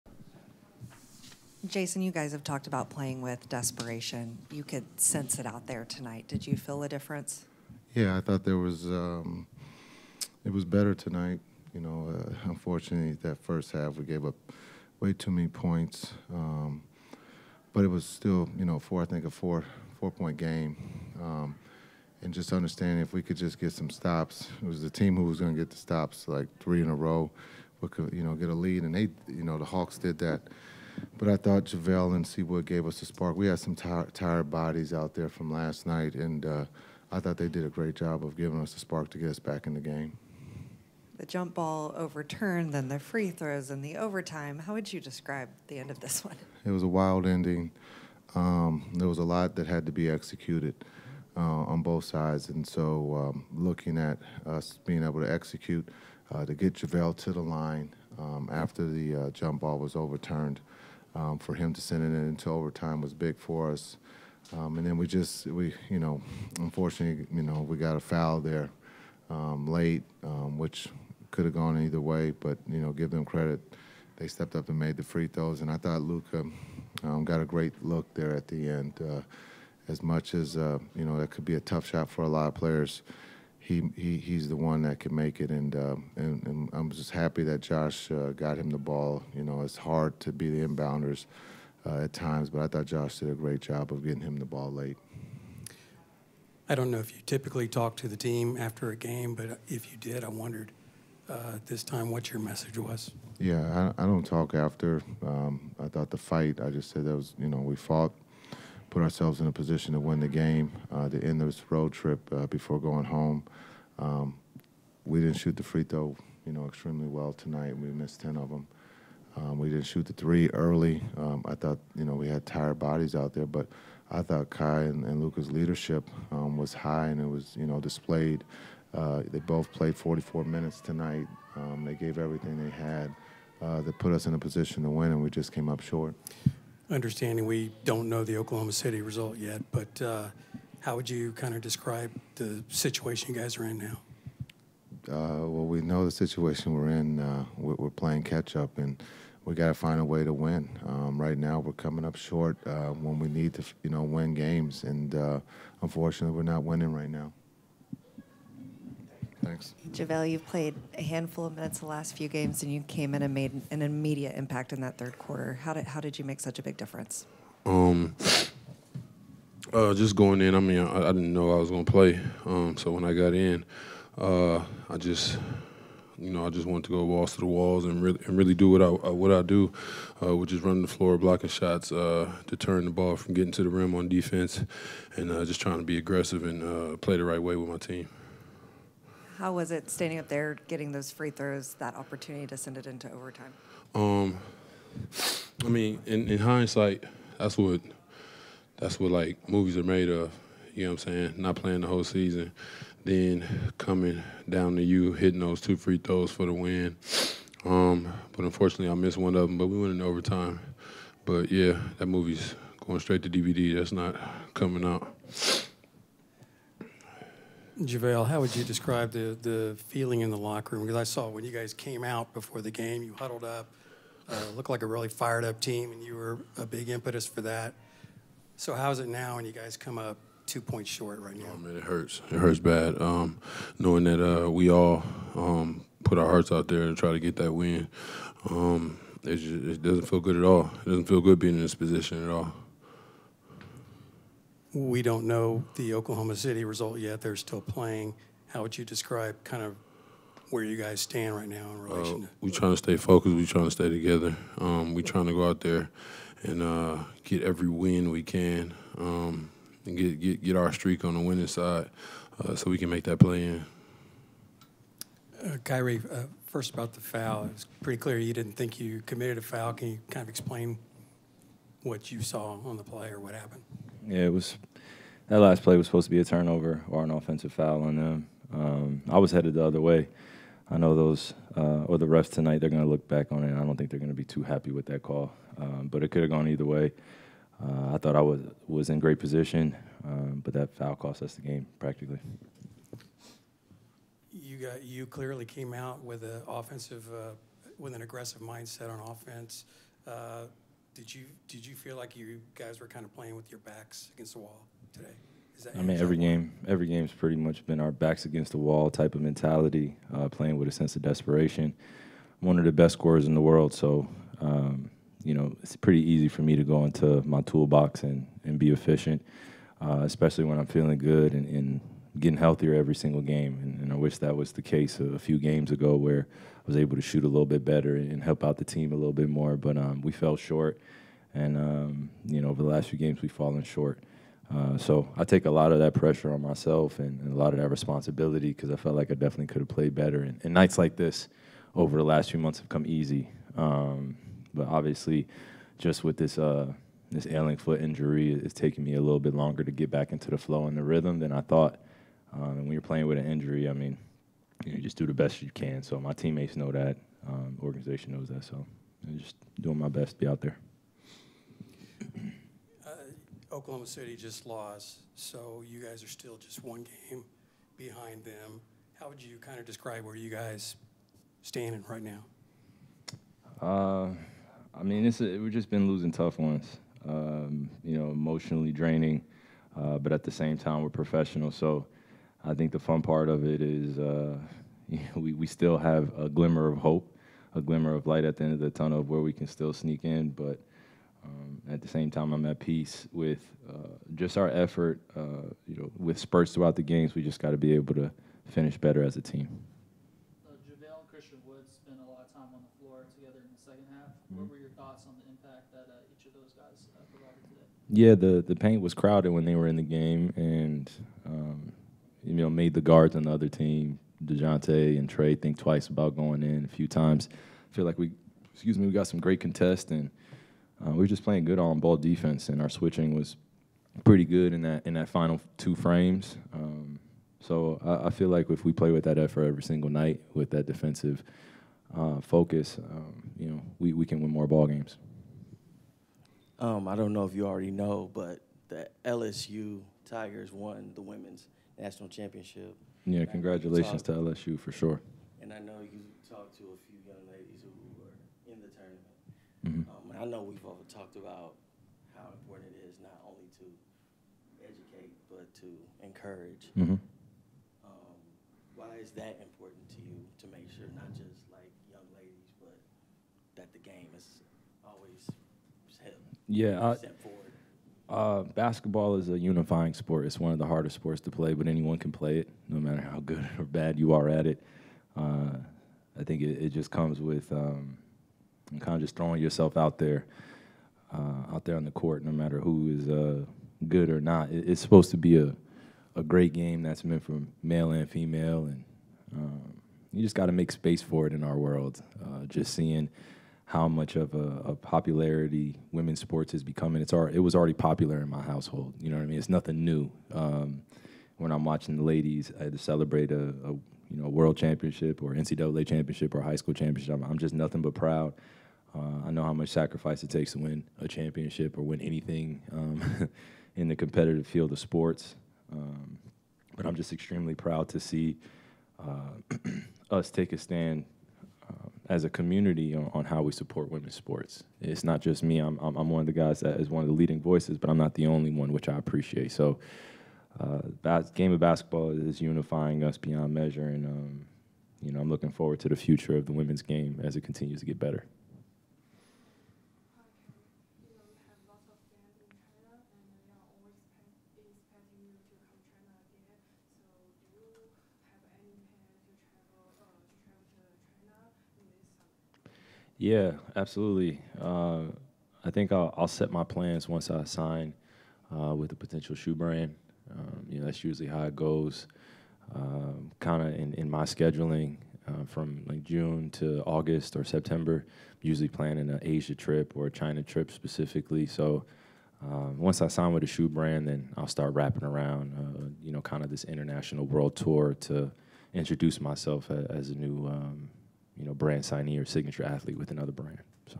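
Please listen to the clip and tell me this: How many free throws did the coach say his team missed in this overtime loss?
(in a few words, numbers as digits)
10.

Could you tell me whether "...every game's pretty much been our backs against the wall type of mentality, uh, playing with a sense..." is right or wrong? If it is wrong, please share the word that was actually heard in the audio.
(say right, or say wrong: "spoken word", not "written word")
right.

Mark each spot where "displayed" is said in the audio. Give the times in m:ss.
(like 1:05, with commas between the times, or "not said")
2:07.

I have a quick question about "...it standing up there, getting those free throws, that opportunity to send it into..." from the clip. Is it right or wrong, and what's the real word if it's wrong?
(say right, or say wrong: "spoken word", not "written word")
right.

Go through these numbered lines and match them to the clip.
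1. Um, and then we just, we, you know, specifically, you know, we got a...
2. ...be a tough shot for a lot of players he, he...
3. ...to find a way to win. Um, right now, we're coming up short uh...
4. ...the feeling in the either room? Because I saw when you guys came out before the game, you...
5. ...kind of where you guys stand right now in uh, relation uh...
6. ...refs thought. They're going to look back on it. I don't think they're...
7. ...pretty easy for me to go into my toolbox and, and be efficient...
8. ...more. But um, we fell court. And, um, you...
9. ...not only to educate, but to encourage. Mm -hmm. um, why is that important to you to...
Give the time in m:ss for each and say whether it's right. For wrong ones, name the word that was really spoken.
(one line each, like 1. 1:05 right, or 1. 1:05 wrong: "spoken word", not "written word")
1. 1:04 wrong: "unfortunately", not "specifically"
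2. 1:21 right
3. 2:29 right
4. 3:39 wrong: "locker", not "either"
5. 4:09 right
6. 4:42 wrong: "tonight", not "thought"
7. 5:15 right
8. 5:29 wrong: "short", not "court"
9. 7:33 right.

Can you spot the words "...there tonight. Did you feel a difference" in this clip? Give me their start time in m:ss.
0:05.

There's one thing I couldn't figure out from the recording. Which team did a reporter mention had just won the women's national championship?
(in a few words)
LSU Tigers.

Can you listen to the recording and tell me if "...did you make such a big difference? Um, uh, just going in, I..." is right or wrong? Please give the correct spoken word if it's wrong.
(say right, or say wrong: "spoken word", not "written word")
right.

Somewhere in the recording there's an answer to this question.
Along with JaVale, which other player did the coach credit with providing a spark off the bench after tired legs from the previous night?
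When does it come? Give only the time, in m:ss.
0:32.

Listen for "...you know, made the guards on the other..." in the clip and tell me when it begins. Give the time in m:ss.
6:52.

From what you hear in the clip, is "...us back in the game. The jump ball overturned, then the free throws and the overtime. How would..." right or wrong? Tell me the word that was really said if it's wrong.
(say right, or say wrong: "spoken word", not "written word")
right.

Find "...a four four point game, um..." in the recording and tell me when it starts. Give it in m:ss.
0:19.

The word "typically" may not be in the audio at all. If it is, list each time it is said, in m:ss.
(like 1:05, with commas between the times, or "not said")
1:37.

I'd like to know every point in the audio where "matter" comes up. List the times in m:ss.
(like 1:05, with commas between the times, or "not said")
7:52, 8:02.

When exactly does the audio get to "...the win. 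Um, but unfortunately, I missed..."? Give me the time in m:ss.
3:26.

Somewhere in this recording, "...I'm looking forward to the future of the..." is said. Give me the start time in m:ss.
8:55.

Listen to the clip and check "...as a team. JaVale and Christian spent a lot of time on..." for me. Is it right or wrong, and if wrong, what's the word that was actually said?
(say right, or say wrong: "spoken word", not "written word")
right.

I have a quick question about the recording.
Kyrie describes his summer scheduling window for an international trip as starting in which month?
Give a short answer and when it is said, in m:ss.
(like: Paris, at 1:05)
June, at 9:26.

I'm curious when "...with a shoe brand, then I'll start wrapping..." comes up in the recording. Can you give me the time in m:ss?
9:33.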